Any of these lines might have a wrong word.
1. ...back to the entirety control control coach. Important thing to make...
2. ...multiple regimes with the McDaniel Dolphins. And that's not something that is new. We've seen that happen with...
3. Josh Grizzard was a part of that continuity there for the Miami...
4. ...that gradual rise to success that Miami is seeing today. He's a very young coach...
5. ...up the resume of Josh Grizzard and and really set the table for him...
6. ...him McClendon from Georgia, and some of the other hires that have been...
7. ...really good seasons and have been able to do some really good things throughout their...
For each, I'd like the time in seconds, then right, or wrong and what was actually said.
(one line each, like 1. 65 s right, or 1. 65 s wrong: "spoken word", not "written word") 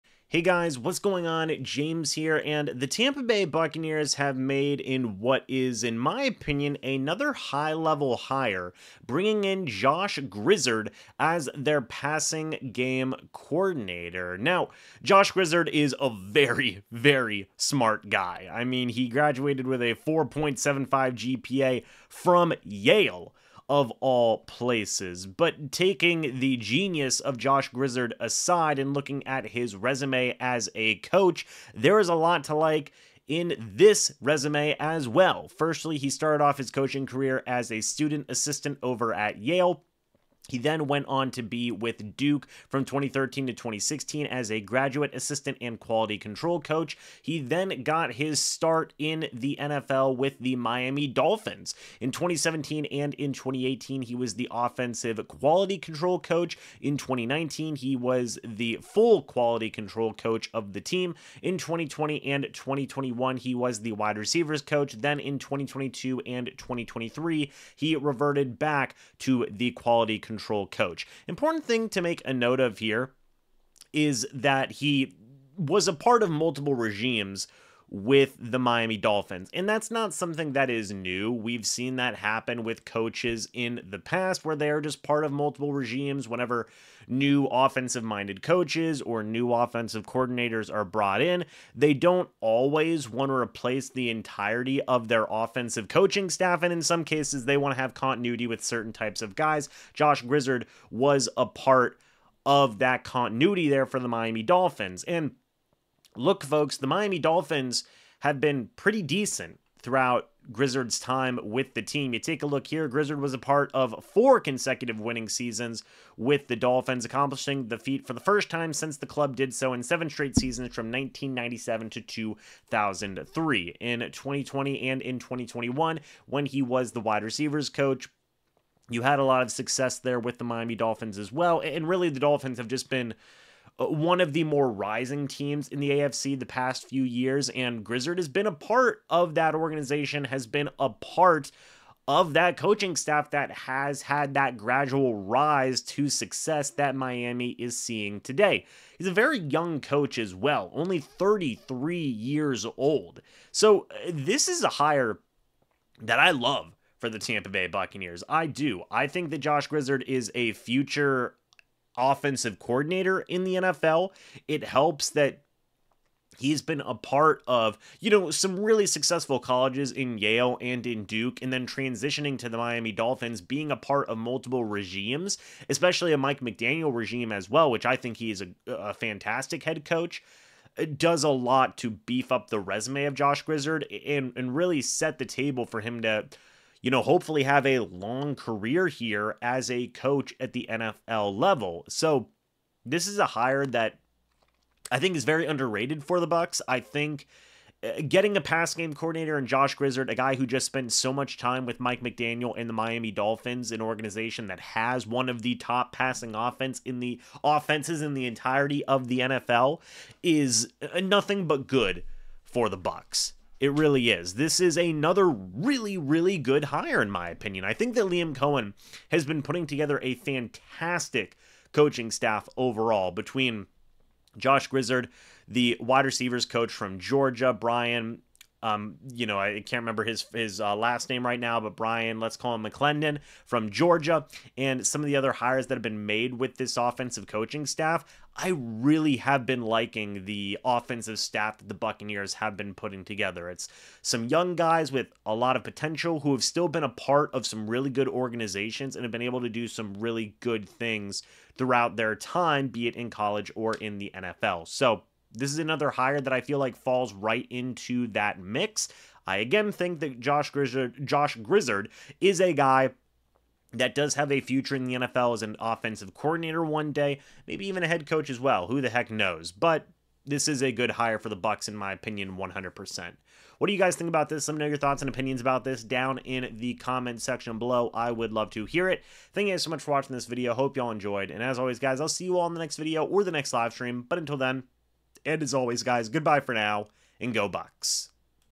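1. 68 s wrong: "quality", not "entirety"
2. 76 s wrong: "Miami", not "McDaniel"
3. 99 s right
4. 144 s right
5. 182 s right
6. 232 s right
7. 247 s wrong: "organizations", not "seasons".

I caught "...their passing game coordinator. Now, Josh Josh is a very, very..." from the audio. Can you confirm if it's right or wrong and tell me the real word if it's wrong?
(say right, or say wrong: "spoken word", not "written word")
wrong: "Grizzard", not "Josh".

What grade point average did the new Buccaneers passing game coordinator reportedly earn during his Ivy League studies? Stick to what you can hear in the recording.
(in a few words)
4.75.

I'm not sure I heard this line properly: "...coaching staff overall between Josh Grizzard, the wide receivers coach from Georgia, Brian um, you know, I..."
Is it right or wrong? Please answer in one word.
right.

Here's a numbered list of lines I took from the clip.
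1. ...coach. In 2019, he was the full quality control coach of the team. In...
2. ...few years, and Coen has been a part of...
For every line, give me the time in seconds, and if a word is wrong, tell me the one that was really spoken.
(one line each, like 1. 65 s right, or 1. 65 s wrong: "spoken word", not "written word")
1. 56 s right
2. 136 s wrong: "Grizzard", not "Coen".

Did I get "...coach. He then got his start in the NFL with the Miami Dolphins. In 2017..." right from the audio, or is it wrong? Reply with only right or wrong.
right.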